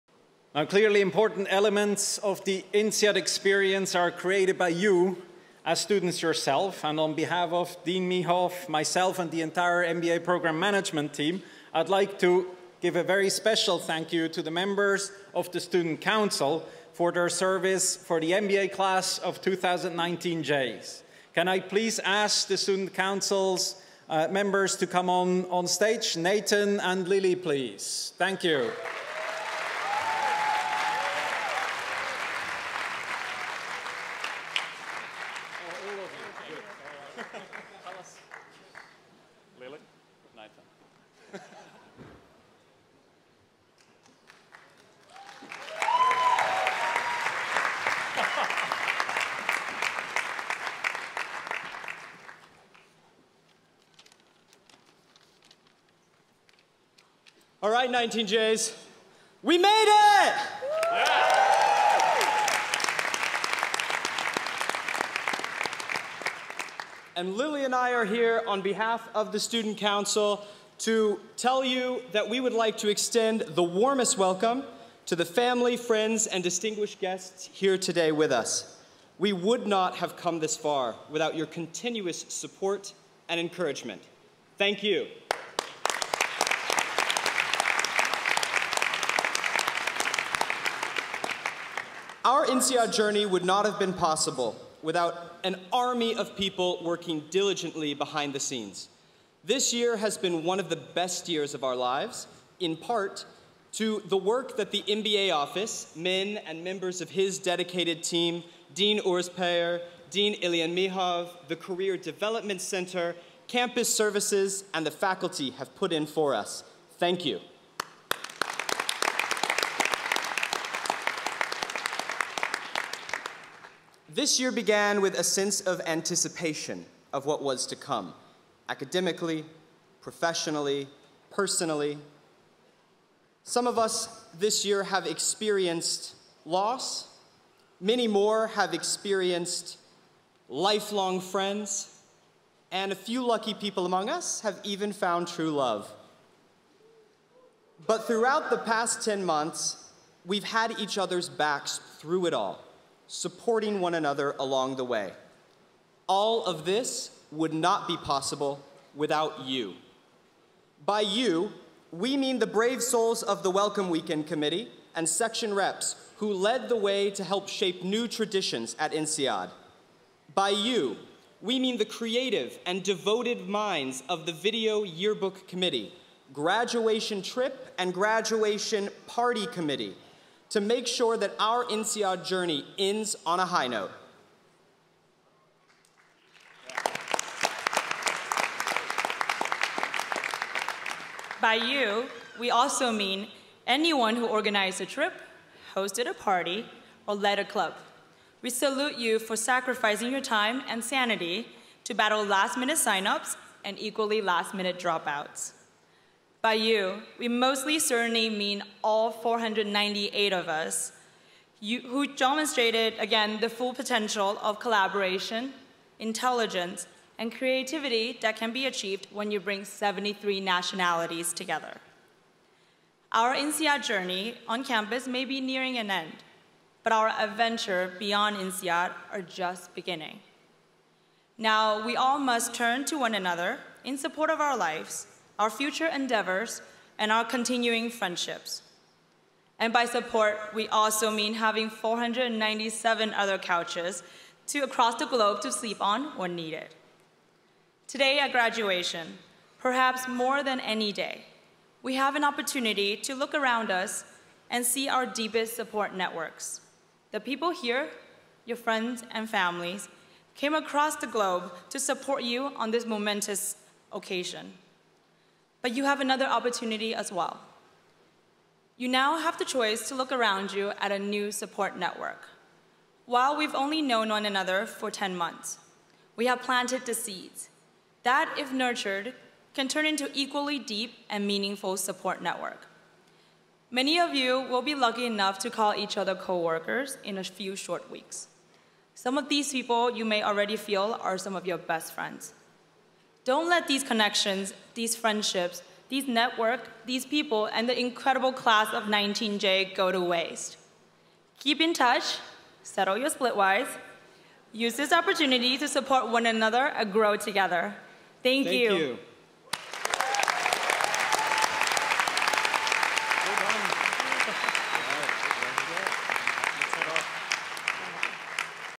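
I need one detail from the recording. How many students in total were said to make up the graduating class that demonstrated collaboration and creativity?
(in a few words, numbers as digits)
498.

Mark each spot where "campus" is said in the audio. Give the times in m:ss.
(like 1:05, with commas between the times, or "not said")
1:53, 3:44.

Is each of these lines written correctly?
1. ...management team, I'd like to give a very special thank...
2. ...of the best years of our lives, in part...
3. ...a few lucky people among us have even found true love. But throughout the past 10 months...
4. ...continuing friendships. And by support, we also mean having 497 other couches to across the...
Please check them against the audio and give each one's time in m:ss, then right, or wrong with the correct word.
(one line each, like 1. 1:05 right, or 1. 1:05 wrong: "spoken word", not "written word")
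1. 0:10 right
2. 1:40 right
3. 2:22 right
4. 3:57 right.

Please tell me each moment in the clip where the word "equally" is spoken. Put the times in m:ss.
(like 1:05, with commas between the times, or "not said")
3:23, 4:40.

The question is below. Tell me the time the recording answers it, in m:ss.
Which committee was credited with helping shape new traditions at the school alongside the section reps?
2:43.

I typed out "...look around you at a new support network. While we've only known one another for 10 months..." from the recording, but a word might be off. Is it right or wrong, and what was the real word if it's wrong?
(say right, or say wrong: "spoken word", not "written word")
right.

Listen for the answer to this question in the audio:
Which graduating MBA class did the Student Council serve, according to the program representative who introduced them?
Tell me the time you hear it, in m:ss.
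0:19.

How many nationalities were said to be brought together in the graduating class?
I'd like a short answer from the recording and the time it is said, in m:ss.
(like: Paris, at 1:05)
73, at 3:39.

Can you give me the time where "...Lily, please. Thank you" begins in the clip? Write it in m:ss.
0:27.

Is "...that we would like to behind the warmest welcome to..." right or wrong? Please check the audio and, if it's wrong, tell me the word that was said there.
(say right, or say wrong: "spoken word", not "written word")
wrong: "extend", not "behind".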